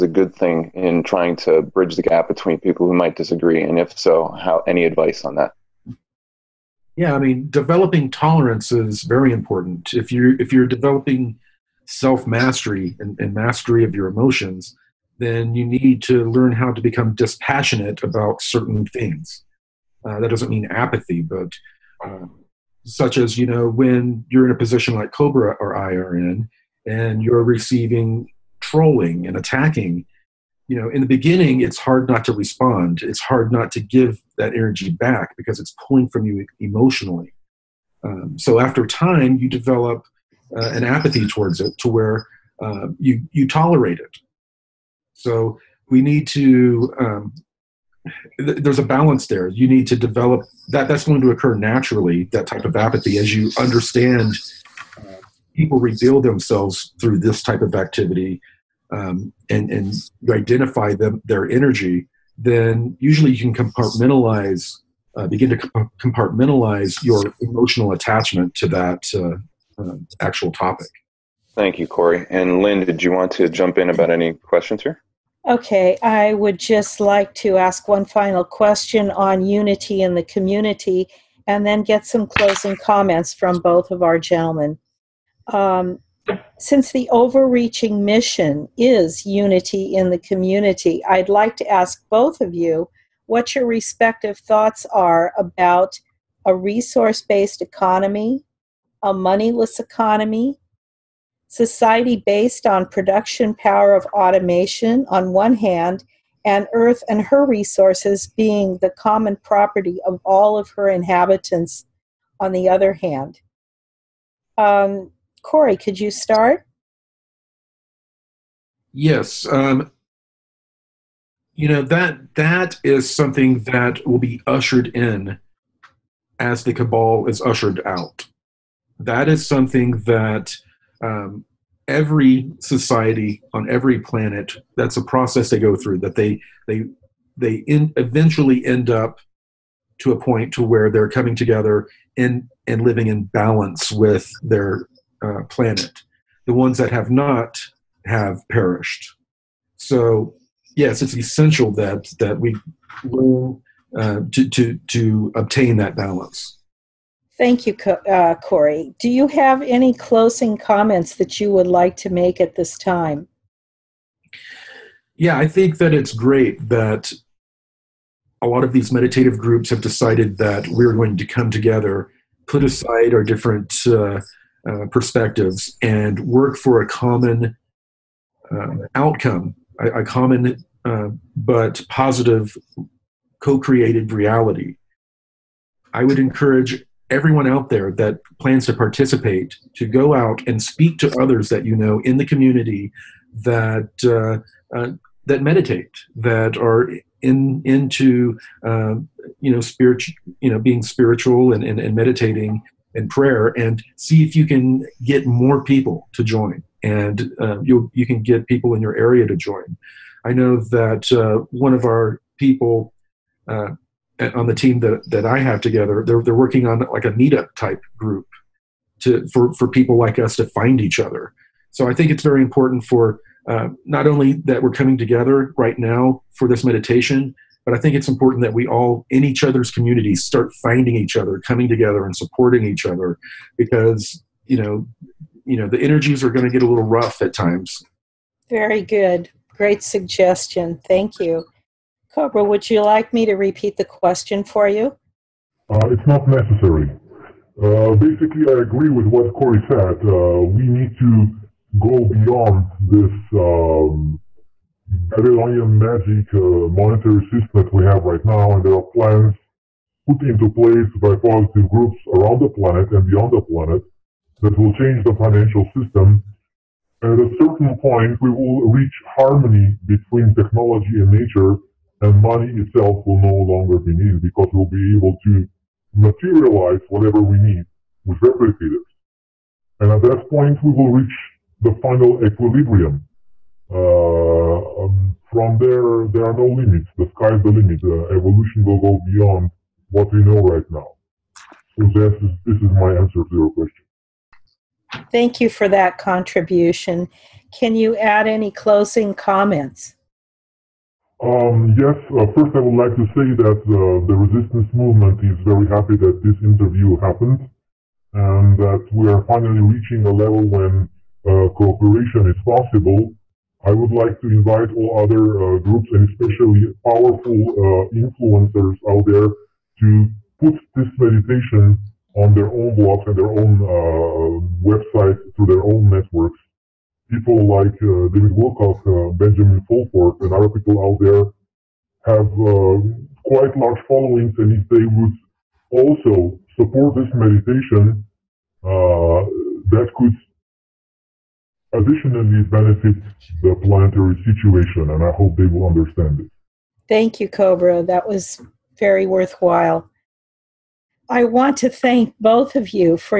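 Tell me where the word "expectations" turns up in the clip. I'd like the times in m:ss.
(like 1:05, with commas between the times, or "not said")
not said.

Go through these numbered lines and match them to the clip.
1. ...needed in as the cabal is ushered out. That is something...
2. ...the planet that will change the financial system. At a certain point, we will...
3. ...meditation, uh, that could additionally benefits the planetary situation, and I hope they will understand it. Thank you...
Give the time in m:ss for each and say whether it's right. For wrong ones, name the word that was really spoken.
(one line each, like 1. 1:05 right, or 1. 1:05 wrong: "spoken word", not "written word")
1. 2:04 wrong: "ushered", not "needed"
2. 4:23 right
3. 5:37 right.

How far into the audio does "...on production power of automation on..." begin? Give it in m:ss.
1:42.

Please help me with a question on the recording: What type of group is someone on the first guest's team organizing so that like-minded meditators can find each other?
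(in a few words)
meetup.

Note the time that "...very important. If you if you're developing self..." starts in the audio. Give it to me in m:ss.
0:09.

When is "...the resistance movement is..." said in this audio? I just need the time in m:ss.
5:04.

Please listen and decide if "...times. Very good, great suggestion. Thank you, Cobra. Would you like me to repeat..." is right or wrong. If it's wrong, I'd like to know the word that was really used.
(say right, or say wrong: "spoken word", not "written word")
right.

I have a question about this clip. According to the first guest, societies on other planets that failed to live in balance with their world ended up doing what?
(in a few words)
perished.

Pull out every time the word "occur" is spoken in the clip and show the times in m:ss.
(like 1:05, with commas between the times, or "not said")
0:51.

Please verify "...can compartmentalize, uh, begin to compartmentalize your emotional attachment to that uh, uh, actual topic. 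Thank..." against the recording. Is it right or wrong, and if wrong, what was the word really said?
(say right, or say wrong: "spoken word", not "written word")
right.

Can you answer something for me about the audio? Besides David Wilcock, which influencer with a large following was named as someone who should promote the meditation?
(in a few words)
Benjamin Fulford.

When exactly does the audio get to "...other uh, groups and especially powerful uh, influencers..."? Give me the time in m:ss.
5:14.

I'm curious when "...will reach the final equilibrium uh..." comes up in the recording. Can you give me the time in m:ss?
4:40.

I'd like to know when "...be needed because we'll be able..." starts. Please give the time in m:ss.
4:33.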